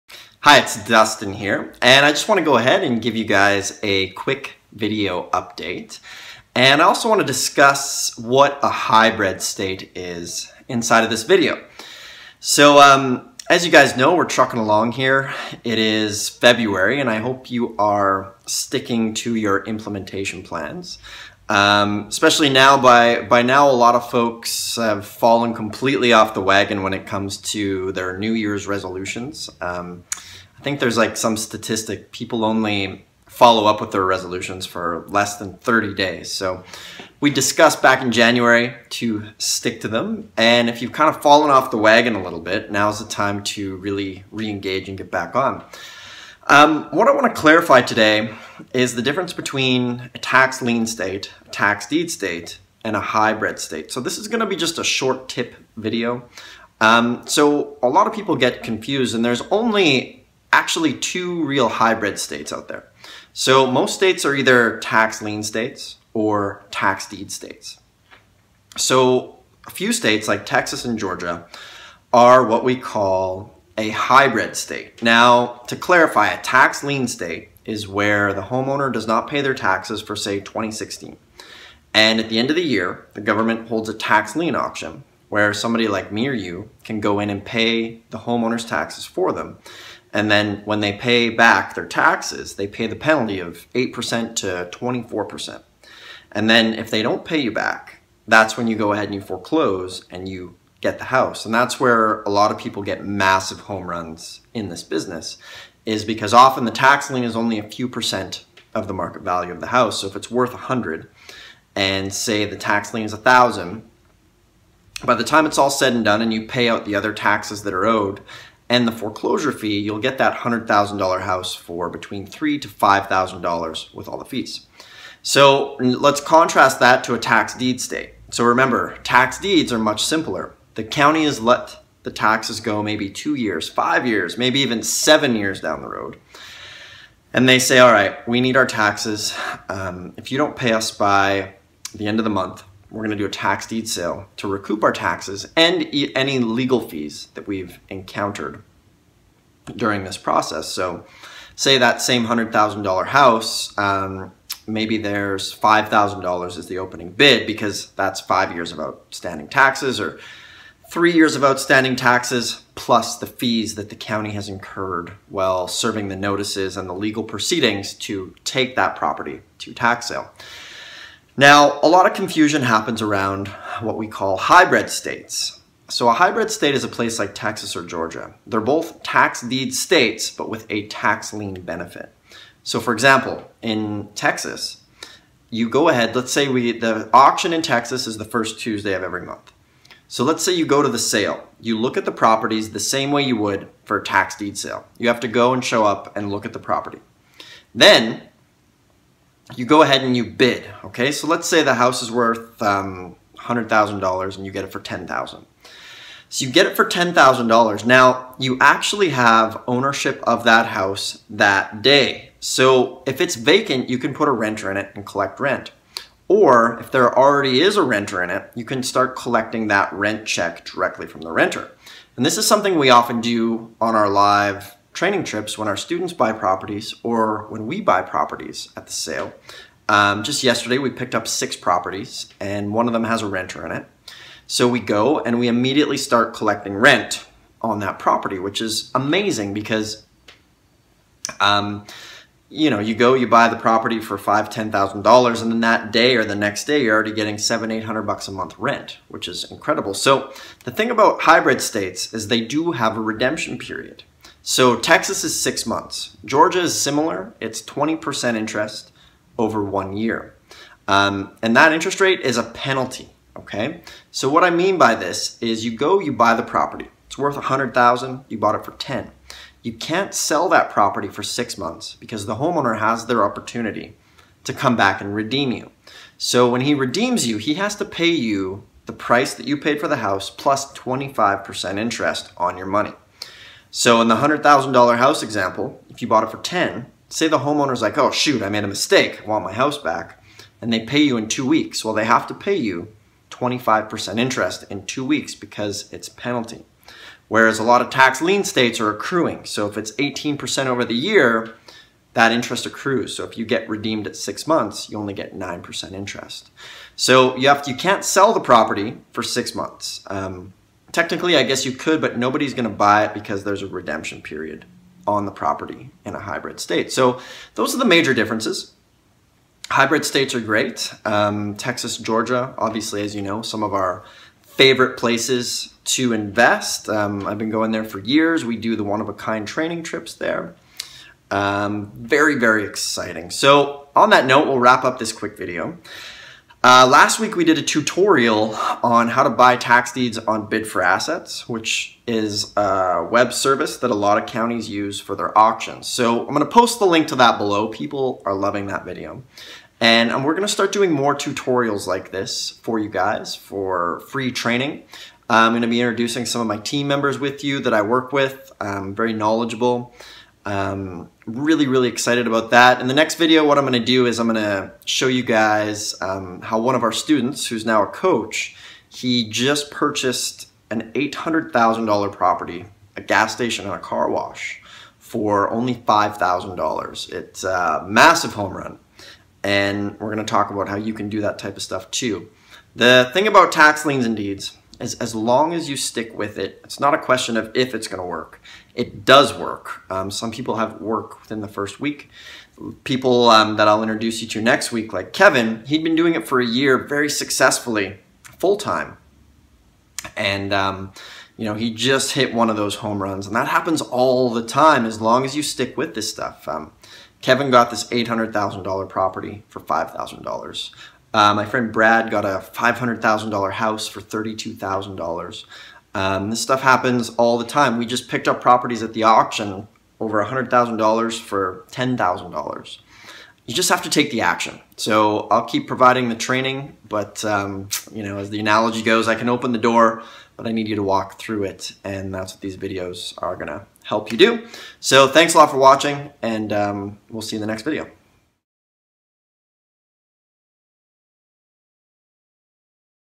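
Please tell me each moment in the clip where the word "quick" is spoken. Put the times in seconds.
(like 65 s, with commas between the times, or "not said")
4 s, 335 s.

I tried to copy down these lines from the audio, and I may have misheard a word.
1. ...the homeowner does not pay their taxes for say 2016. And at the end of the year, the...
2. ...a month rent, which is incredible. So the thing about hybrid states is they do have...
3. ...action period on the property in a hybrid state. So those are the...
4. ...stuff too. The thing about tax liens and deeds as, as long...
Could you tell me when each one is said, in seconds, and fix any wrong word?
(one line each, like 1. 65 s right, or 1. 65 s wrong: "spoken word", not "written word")
1. 78 s right
2. 248 s right
3. 313 s wrong: "redemption", not "action"
4. 381 s right.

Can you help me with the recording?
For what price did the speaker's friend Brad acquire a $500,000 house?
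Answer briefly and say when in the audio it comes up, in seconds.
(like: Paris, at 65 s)
$32,000, at 414 s.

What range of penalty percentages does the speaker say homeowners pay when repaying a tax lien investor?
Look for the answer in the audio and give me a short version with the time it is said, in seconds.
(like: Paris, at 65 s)
8% to 24%, at 93 s.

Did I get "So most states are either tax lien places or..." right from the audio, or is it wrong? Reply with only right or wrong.
wrong.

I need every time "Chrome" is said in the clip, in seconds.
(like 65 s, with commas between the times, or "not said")
not said.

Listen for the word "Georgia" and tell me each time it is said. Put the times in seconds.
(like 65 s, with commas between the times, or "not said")
70 s, 177 s, 256 s, 321 s.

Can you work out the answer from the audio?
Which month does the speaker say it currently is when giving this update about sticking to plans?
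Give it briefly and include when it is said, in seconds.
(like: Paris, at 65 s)
February, at 16 s.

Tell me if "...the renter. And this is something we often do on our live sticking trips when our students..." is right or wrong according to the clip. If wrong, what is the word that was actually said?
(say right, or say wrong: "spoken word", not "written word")
wrong: "training", not "sticking".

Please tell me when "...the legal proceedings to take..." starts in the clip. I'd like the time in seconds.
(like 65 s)
166 s.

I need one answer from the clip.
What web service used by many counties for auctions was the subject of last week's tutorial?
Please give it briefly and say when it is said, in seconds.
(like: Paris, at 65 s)
Bid for Assets, at 340 s.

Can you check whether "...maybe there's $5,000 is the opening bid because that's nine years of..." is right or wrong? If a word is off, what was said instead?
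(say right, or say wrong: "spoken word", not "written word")
wrong: "five", not "nine".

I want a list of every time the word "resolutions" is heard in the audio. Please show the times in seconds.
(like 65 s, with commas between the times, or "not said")
28 s, 34 s.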